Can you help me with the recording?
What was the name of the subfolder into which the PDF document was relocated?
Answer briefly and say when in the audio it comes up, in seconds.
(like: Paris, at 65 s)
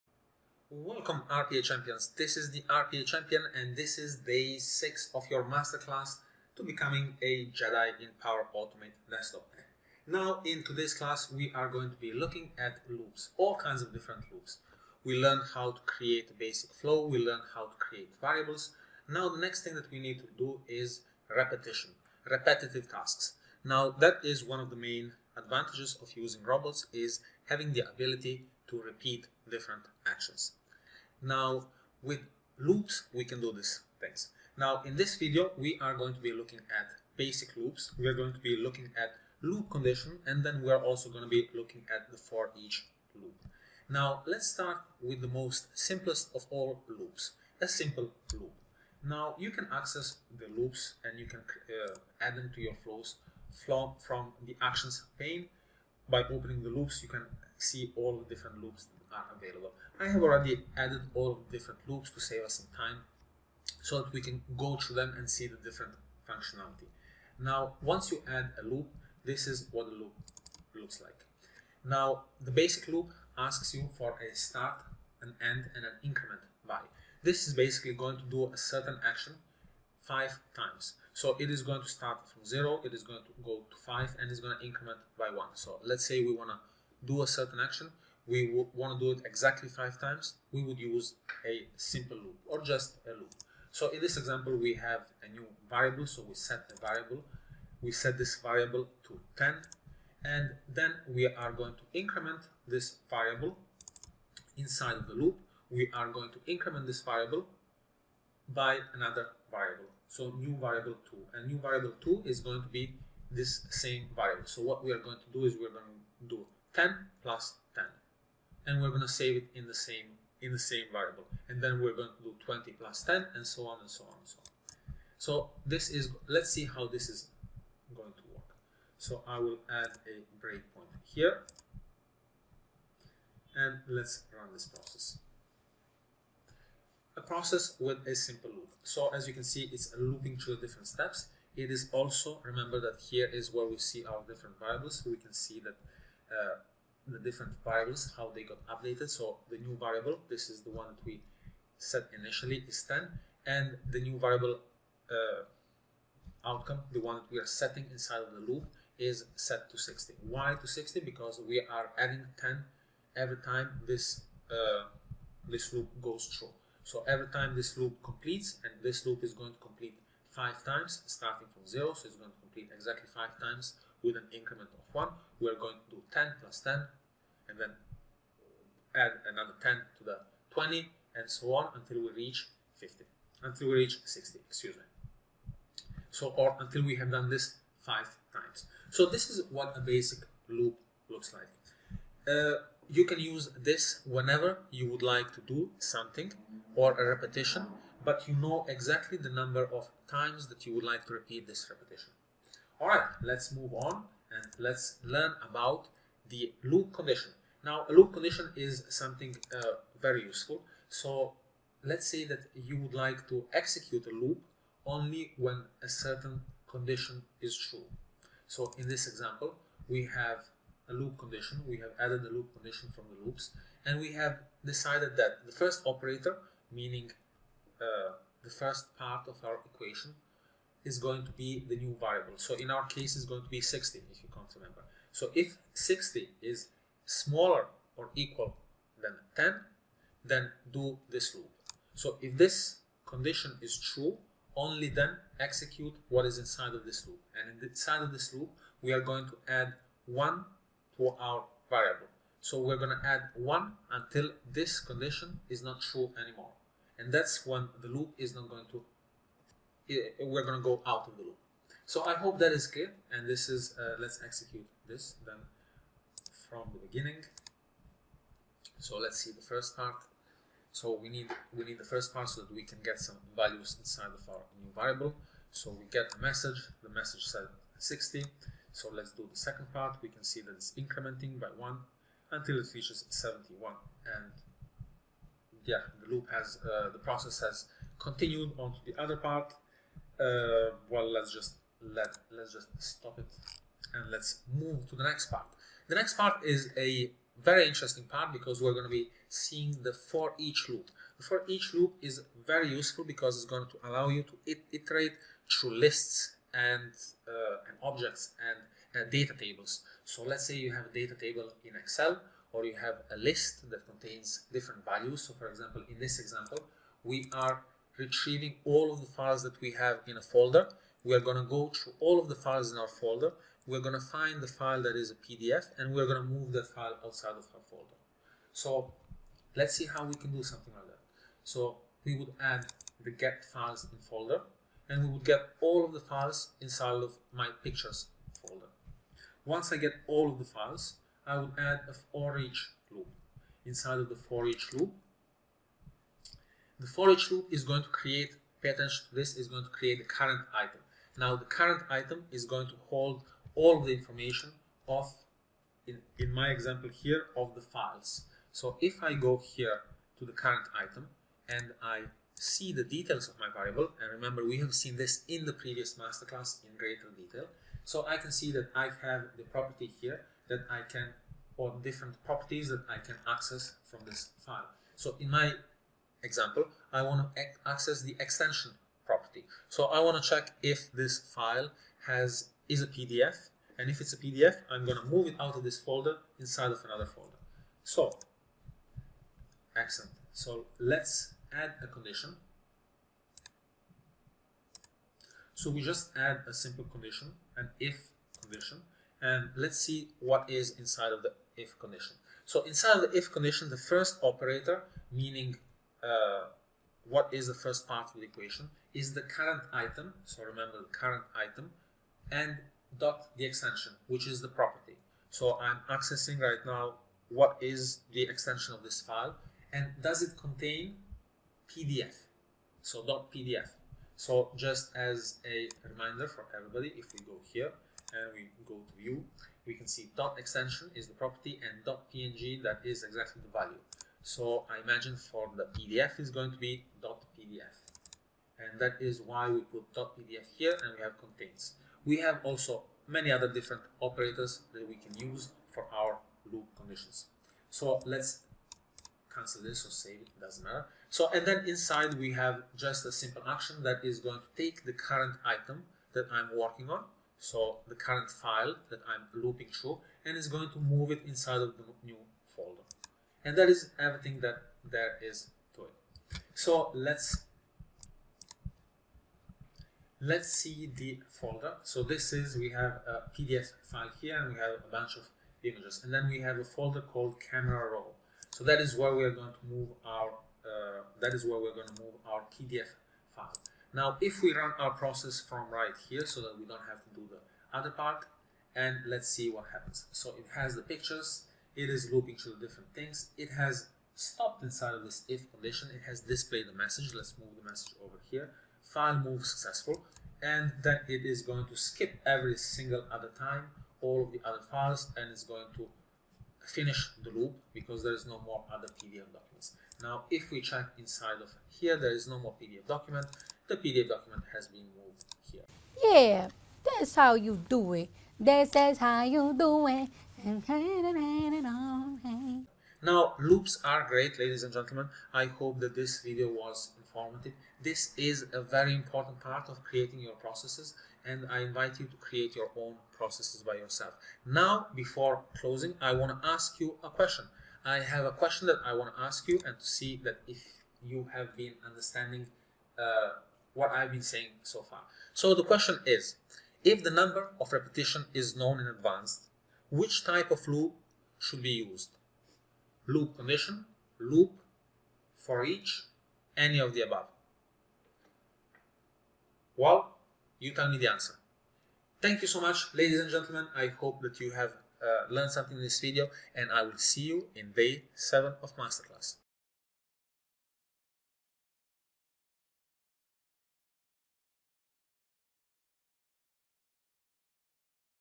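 Camera Roll, at 477 s.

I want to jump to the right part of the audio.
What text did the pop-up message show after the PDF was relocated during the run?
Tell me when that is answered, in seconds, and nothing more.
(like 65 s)
498 s.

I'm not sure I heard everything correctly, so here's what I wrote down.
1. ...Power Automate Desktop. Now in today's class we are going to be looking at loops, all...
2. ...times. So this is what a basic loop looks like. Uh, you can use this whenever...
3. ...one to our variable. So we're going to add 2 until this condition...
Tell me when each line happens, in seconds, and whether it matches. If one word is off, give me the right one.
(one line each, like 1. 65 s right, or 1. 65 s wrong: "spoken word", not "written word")
1. 8 s right
2. 188 s right
3. 250 s wrong: "1", not "2".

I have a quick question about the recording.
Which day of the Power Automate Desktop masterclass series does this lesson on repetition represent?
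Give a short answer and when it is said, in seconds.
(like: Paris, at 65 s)
6, at 4 s.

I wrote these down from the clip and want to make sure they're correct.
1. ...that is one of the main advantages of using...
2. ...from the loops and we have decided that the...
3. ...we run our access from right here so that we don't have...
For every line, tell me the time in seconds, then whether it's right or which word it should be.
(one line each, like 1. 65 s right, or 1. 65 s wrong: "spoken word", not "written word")
1. 23 s right
2. 222 s right
3. 484 s wrong: "process", not "access".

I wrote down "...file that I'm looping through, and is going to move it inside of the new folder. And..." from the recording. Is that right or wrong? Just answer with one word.
right.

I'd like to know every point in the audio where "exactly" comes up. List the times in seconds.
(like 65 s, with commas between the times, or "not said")
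89 s, 172 s, 198 s, 433 s.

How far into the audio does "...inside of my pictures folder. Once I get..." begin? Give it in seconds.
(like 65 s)
336 s.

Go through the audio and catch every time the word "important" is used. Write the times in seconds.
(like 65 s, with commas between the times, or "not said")
528 s.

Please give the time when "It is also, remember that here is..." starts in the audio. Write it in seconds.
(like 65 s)
141 s.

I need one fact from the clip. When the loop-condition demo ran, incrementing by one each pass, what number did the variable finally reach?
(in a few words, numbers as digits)
71.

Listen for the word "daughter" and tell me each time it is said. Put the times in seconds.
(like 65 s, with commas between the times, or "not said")
not said.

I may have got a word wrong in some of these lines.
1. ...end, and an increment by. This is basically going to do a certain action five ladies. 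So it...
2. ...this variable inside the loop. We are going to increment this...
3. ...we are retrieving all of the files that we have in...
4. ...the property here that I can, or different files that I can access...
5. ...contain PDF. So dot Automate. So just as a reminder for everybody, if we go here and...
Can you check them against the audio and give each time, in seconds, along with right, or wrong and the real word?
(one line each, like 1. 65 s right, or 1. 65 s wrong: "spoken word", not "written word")
1. 75 s wrong: "times", not "ladies"
2. 102 s right
3. 317 s right
4. 369 s wrong: "properties", not "files"
5. 420 s wrong: "PDF", not "Automate".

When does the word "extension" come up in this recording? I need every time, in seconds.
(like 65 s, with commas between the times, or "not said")
378 s, 413 s, 418 s, 430 s.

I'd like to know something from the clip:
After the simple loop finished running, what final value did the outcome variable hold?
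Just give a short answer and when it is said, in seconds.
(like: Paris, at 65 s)
60, at 159 s.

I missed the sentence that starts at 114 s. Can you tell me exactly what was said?
So what we are going to do is we're going to do 10 plus 10.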